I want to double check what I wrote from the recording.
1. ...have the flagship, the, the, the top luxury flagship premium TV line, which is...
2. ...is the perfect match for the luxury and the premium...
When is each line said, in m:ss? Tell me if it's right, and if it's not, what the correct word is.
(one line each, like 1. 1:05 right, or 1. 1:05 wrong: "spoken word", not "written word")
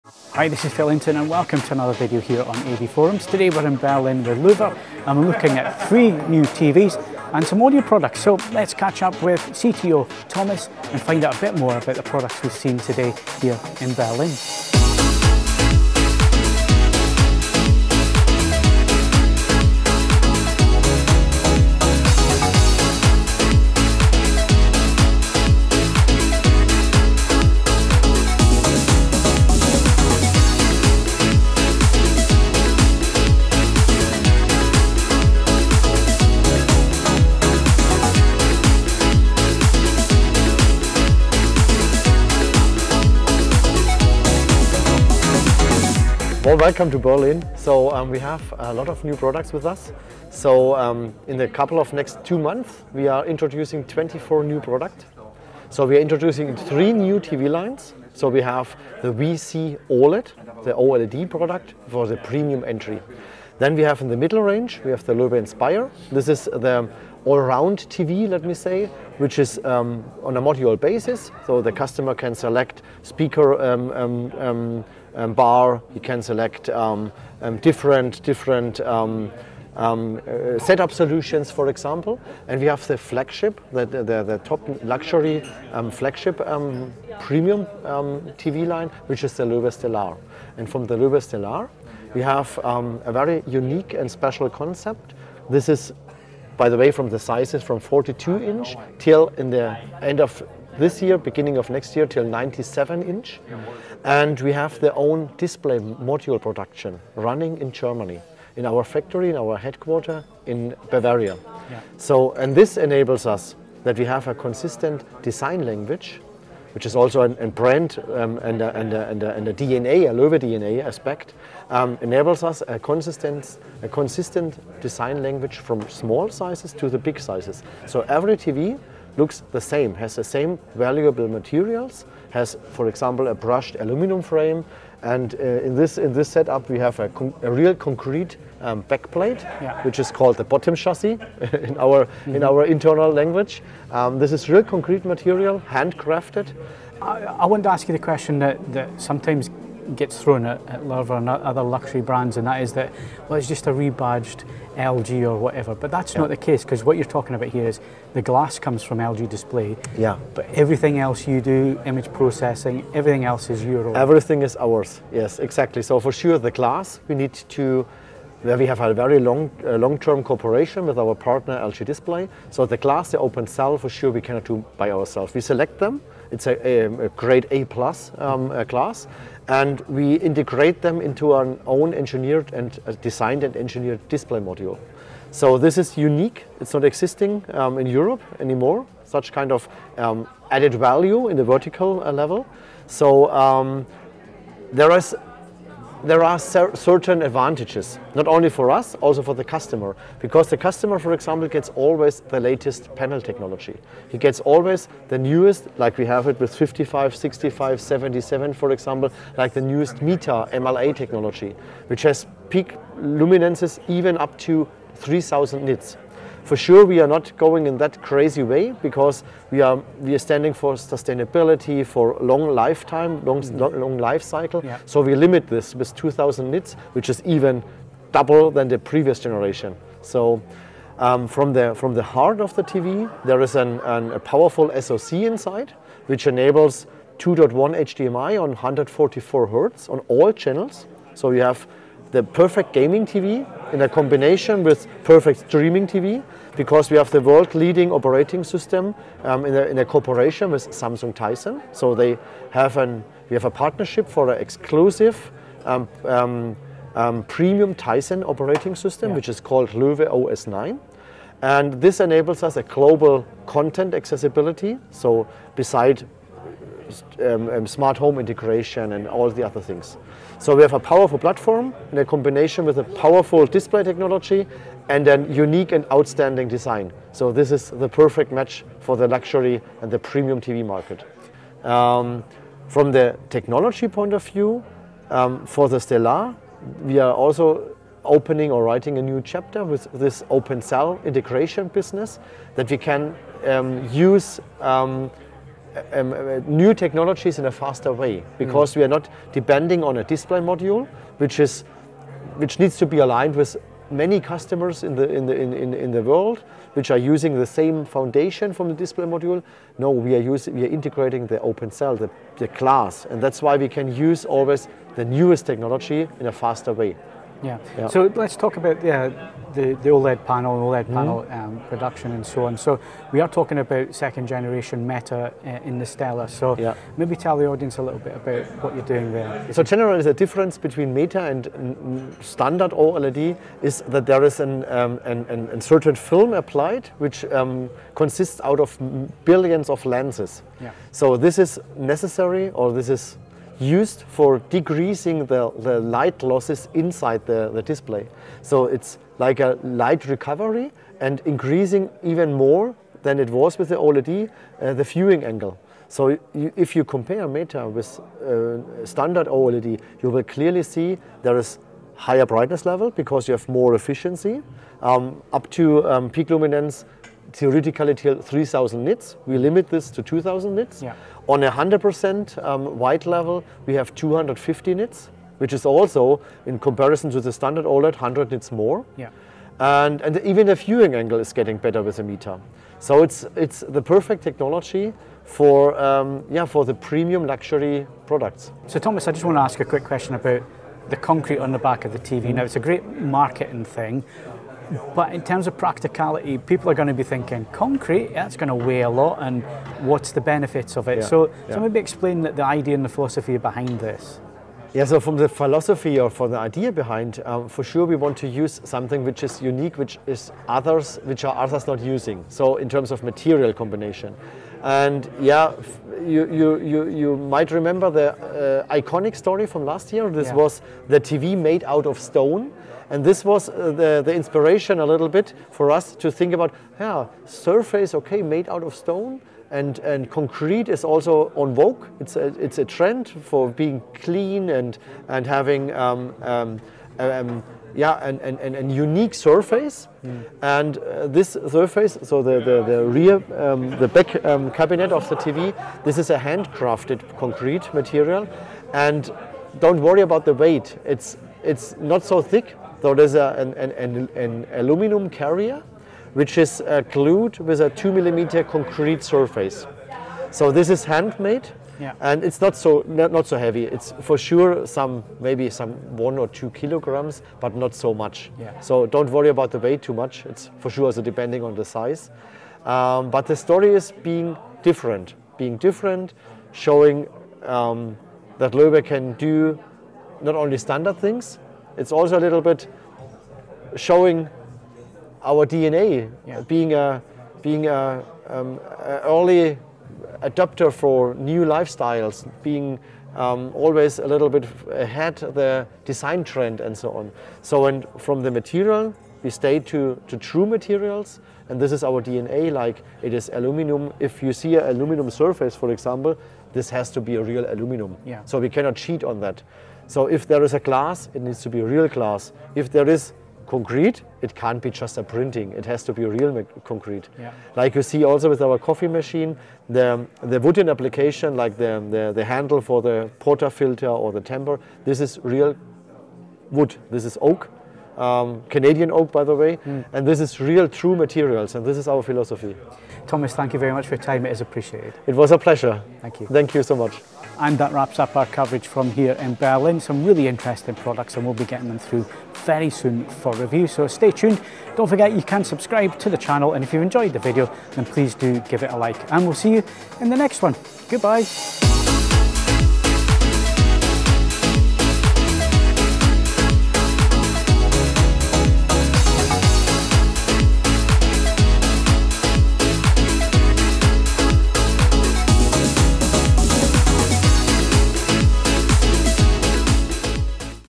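1. 1:22 right
2. 4:37 right.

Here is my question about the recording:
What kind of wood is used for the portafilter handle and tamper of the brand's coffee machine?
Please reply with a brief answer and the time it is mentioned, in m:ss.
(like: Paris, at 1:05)
Canadian oak, at 8:48.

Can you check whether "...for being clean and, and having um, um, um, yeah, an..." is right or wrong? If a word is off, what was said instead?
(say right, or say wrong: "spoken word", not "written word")
right.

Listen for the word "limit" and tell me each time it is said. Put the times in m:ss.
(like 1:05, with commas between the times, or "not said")
3:45, 6:09.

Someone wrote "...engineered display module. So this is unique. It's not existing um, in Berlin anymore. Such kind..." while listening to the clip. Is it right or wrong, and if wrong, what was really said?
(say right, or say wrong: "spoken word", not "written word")
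wrong: "Europe", not "Berlin".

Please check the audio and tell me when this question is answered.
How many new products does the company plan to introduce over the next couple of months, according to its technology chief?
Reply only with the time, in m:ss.
0:53.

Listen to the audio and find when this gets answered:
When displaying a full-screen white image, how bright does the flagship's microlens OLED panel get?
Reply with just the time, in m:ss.
6:13.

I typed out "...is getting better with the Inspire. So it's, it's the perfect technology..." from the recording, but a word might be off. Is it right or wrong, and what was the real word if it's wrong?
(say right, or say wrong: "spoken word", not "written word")
wrong: "Meta", not "Inspire".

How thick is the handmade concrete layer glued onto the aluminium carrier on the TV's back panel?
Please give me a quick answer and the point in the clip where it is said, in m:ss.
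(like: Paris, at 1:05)
2 millimeters, at 7:37.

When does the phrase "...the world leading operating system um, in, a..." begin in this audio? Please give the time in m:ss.
4:07.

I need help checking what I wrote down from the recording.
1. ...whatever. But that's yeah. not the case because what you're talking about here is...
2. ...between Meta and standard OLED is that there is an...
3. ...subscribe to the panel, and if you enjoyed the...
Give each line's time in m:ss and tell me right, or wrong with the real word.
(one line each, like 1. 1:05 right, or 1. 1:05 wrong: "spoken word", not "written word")
1. 2:35 right
2. 5:30 right
3. 9:05 wrong: "channel", not "panel".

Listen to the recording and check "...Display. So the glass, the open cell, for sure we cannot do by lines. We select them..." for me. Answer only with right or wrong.
wrong.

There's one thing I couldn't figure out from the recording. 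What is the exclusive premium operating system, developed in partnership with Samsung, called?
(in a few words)
Loewe OS 9.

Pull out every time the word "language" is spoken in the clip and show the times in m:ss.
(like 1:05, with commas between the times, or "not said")
1:55, 2:05, 2:23.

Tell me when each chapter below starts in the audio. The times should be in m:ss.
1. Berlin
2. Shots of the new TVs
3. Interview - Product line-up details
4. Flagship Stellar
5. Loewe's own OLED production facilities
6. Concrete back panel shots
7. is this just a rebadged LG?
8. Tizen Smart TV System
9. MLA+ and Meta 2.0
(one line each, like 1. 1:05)
1. 0:14
2. 0:31
3. 0:48
4. 1:23
5. 1:46
6. 2:18
7. 2:29
8. 3:56
9. 4:44.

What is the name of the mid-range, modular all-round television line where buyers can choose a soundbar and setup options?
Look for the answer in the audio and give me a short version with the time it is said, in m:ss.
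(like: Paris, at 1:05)
Loewe Inspire, at 1:05.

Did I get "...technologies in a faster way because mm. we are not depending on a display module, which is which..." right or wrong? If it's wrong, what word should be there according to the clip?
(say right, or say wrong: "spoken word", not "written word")
right.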